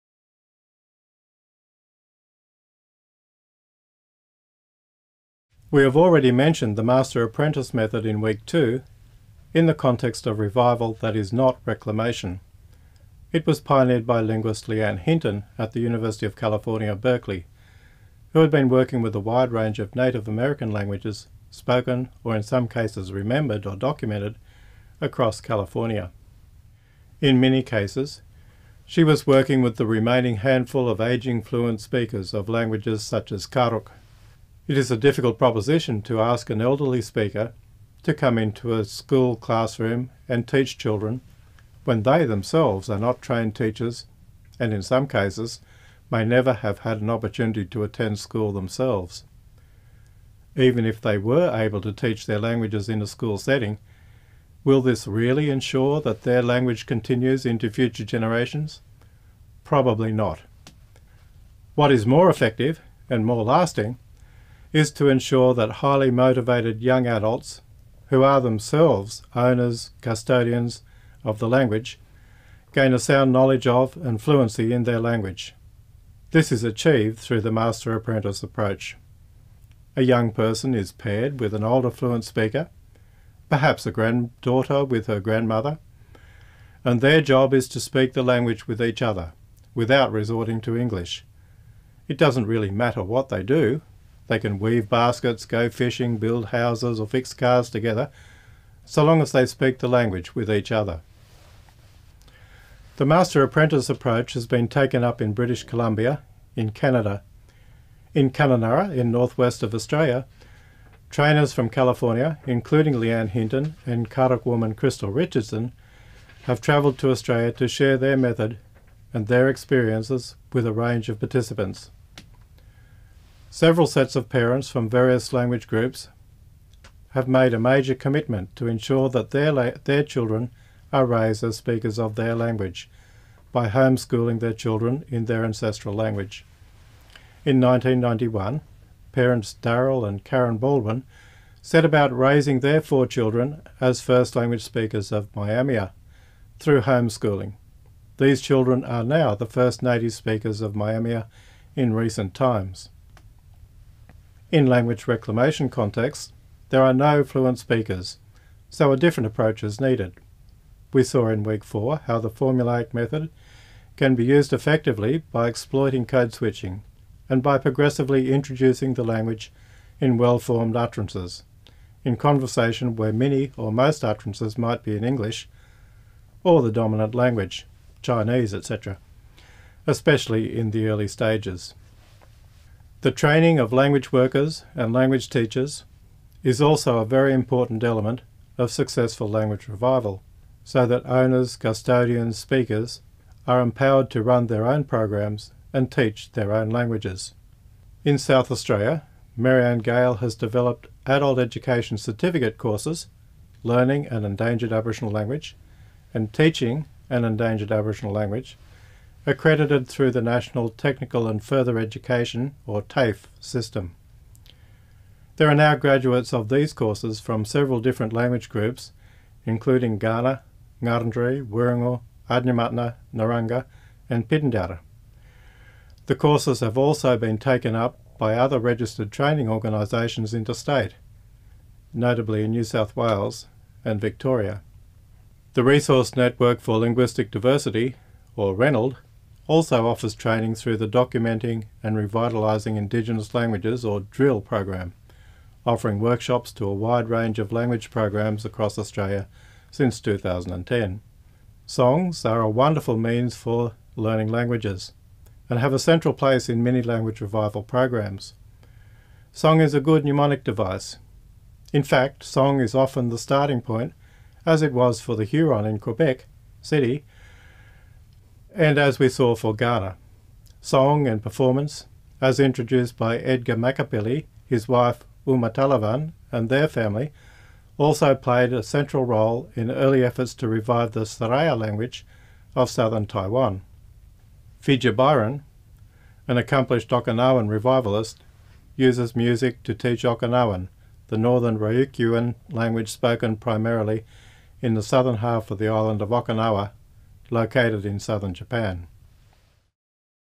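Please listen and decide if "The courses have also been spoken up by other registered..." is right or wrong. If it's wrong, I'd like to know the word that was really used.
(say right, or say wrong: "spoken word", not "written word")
wrong: "taken", not "spoken".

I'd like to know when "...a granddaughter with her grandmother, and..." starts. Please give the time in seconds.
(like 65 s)
83 s.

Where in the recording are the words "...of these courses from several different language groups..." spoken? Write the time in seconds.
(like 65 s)
216 s.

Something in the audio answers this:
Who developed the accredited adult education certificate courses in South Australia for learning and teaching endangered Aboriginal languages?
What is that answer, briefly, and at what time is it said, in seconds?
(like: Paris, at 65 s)
Mary-Anne Gale, at 199 s.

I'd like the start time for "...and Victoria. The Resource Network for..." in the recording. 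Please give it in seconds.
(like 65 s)
233 s.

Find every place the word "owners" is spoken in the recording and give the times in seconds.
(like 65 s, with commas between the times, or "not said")
69 s, 191 s.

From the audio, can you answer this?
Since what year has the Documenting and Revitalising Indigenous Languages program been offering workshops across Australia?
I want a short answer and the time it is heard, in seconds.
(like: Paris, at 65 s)
2010, at 249 s.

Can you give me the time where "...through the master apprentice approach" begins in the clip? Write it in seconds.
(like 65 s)
77 s.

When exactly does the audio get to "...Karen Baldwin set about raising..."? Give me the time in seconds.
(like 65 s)
140 s.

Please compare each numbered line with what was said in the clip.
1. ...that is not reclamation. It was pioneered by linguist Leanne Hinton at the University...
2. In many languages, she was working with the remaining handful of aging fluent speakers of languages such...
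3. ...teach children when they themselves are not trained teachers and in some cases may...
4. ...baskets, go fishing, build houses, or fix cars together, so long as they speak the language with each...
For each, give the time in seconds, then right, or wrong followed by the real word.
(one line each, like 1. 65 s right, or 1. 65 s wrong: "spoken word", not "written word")
1. 10 s right
2. 27 s wrong: "cases", not "languages"
3. 40 s right
4. 94 s right.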